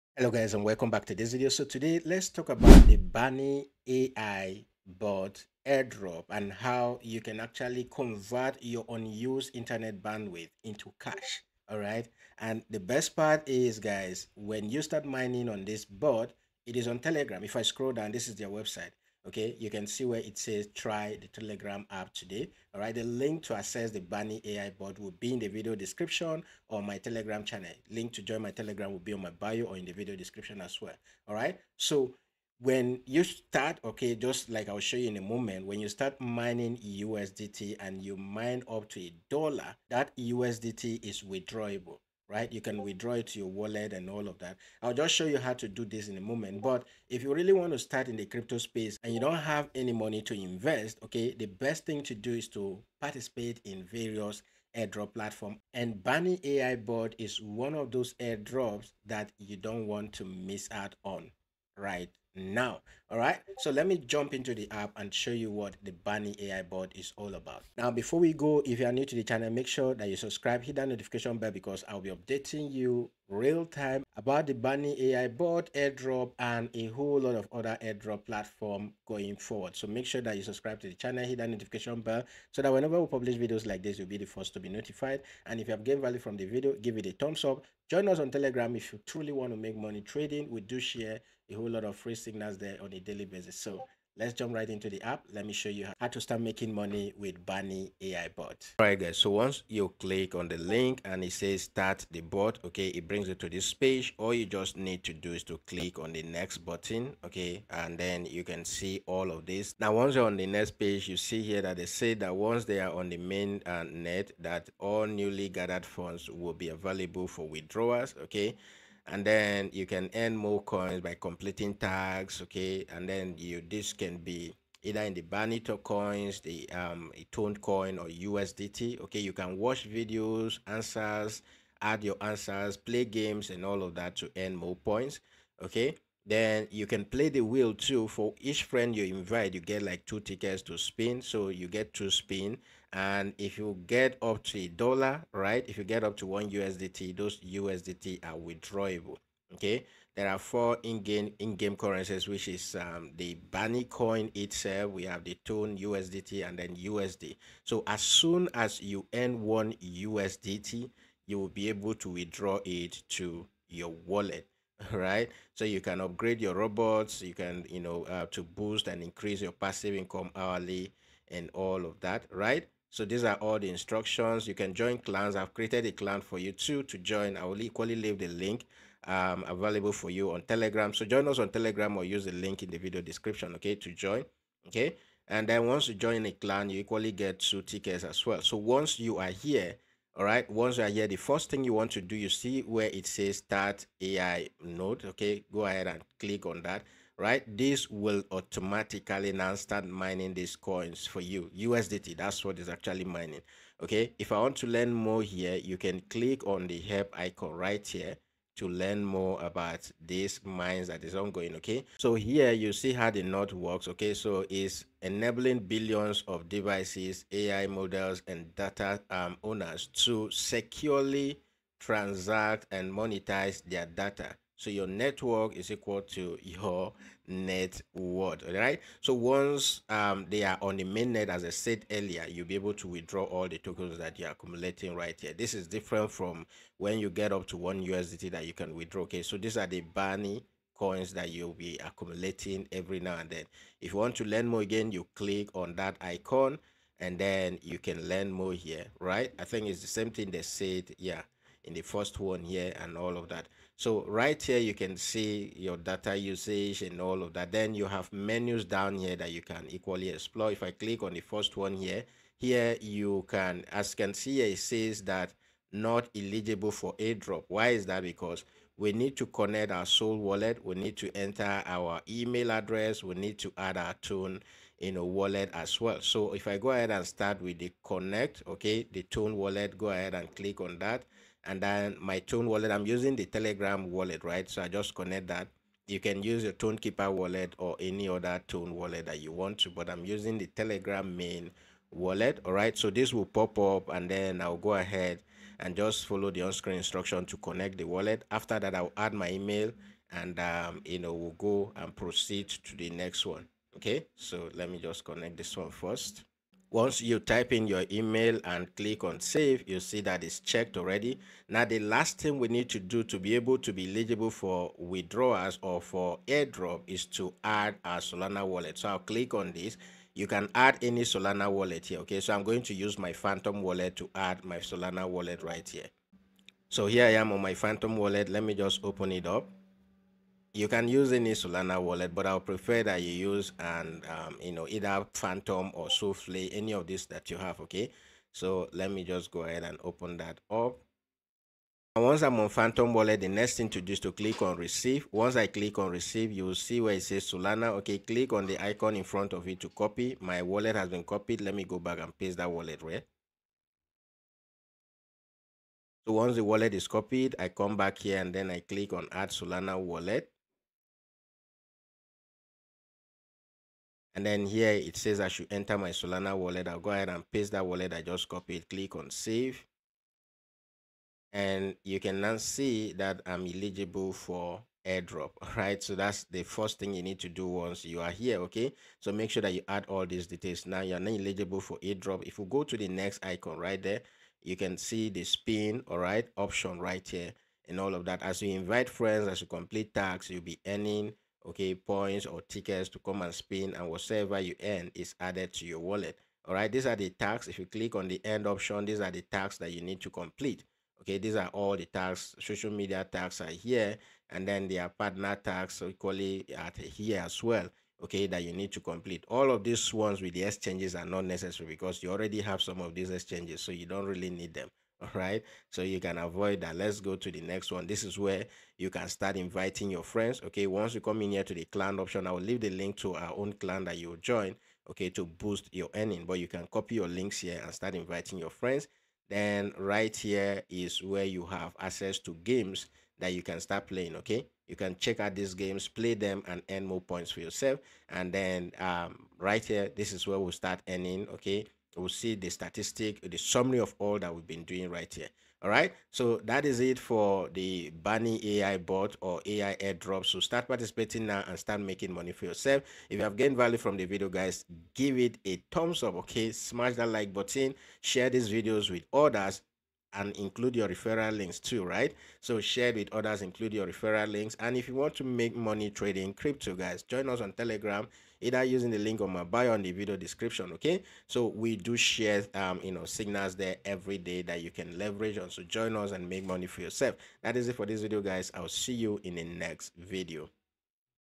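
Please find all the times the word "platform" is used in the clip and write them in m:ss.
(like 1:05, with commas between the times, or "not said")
0:55, 1:18.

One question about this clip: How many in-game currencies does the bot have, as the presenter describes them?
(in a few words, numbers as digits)
4.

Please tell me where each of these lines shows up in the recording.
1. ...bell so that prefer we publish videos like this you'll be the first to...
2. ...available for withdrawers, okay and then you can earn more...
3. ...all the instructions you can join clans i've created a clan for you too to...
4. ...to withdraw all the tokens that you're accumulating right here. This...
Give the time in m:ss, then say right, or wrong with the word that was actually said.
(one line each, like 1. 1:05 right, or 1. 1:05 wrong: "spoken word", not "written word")
1. 1:21 wrong: "whenever", not "prefer"
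2. 1:56 right
3. 2:53 right
4. 3:52 right.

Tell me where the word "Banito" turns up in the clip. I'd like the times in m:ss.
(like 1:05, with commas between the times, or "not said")
2:05.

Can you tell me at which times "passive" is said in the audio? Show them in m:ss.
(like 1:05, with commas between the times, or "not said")
2:49.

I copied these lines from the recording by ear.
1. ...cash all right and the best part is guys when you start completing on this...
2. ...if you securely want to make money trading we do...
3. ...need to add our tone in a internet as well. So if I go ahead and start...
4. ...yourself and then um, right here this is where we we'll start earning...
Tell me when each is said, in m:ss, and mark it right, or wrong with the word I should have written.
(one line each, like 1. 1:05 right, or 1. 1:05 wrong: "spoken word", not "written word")
1. 0:10 wrong: "mining", not "completing"
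2. 1:28 wrong: "truly", not "securely"
3. 4:33 wrong: "wallet", not "internet"
4. 7:17 right.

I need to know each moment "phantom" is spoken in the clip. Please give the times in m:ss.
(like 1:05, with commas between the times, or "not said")
5:23, 5:27, 5:35, 5:42.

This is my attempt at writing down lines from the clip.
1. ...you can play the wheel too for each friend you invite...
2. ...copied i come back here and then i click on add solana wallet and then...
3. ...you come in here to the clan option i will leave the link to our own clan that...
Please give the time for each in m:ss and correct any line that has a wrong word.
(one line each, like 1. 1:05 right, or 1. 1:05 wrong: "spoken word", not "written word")
1. 2:16 right
2. 5:56 right
3. 7:00 right.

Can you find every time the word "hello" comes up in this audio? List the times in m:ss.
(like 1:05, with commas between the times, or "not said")
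0:00.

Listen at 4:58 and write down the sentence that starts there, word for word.
After that, I'll add my email, and um, you know we'll go and proceed to the next one.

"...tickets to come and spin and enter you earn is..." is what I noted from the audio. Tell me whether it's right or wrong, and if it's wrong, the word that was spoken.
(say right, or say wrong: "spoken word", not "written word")
wrong: "whatever", not "enter".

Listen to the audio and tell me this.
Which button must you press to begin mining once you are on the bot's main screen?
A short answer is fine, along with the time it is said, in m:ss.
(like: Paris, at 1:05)
start ai node, at 3:13.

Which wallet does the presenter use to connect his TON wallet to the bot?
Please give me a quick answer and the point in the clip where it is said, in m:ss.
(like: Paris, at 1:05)
Telegram wallet, at 4:43.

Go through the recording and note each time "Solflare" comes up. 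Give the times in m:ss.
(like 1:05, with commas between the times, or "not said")
5:35.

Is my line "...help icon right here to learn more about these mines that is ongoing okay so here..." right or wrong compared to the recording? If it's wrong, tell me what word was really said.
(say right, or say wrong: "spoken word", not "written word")
right.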